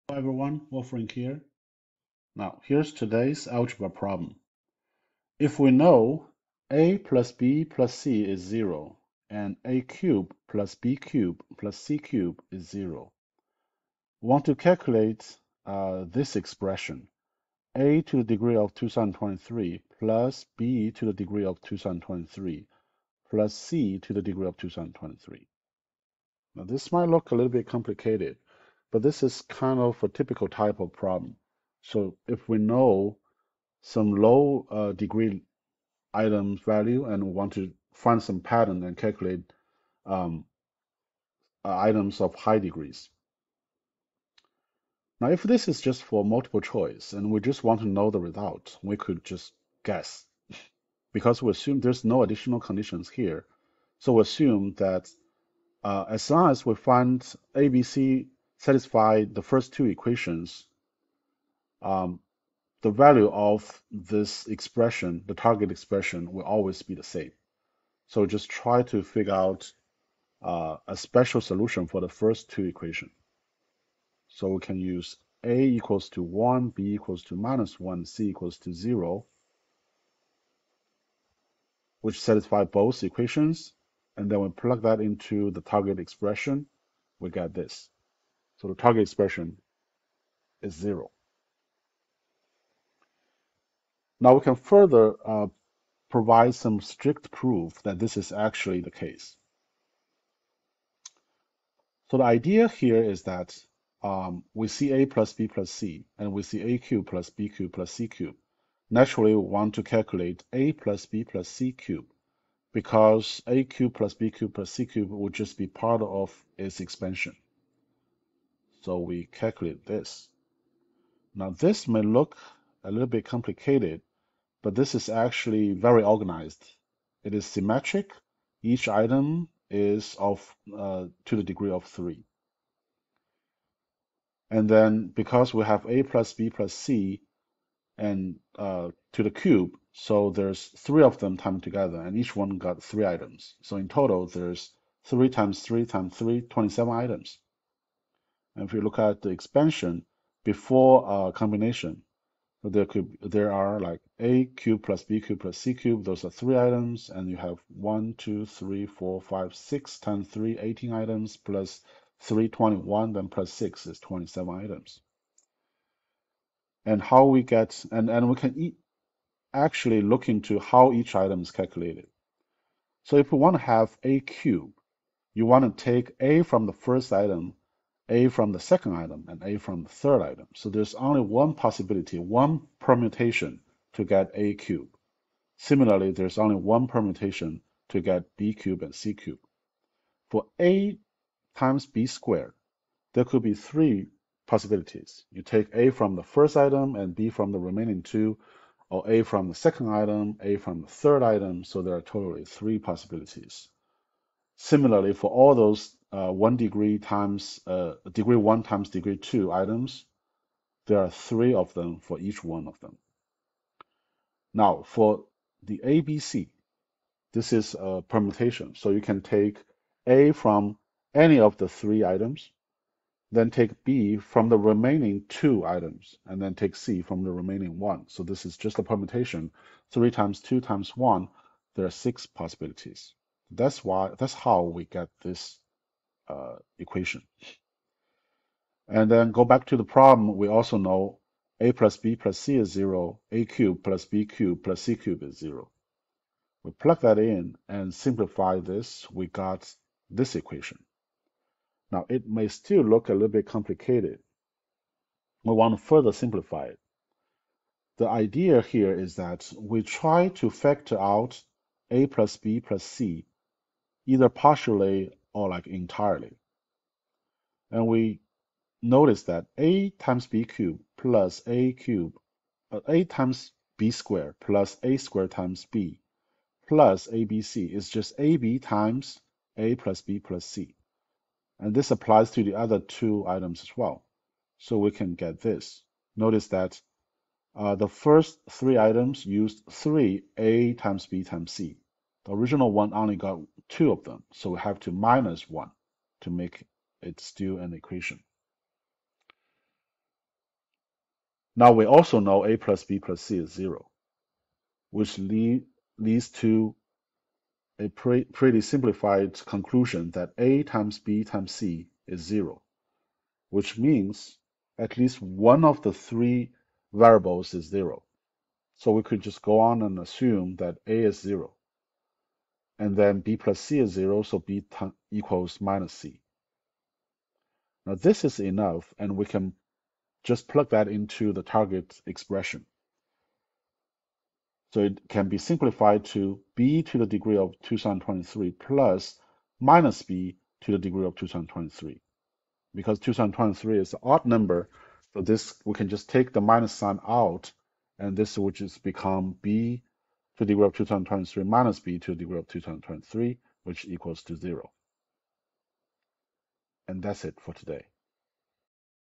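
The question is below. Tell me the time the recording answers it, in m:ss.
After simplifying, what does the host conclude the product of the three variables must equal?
5:10.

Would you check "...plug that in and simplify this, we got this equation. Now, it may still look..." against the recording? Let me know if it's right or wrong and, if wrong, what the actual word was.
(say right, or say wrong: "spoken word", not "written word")
right.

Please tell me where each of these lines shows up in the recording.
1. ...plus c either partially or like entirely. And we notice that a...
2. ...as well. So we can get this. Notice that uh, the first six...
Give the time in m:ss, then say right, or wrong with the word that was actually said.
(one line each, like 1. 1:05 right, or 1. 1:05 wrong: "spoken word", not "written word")
1. 4:22 right
2. 4:43 wrong: "three", not "six".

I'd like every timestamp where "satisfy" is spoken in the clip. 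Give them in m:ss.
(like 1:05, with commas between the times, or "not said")
0:58, 1:22.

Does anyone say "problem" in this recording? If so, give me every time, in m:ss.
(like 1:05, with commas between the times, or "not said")
0:03, 0:30, 3:59.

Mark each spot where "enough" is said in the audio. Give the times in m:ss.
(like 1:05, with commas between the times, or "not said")
5:28.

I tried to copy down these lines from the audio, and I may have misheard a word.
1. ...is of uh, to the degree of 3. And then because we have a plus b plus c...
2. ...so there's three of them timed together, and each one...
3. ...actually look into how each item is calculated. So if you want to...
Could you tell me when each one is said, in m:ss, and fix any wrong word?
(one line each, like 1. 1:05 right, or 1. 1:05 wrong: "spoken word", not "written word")
1. 2:09 right
2. 2:19 right
3. 2:49 right.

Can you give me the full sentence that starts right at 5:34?
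So it can be simplified to b to the degree of two thousand twenty-three plus minus b to the degree of 223.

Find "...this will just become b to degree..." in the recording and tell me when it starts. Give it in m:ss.
5:48.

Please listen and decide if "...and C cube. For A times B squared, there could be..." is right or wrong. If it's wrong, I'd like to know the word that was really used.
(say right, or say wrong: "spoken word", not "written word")
right.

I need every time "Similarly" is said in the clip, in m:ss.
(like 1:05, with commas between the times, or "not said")
3:05, 3:24.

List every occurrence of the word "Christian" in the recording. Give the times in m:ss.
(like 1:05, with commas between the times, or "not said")
not said.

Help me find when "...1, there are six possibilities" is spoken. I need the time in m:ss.
3:50.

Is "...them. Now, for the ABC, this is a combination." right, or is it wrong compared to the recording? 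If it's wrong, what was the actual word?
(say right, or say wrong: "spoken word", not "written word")
wrong: "permutation", not "combination".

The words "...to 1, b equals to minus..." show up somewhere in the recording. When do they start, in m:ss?
1:16.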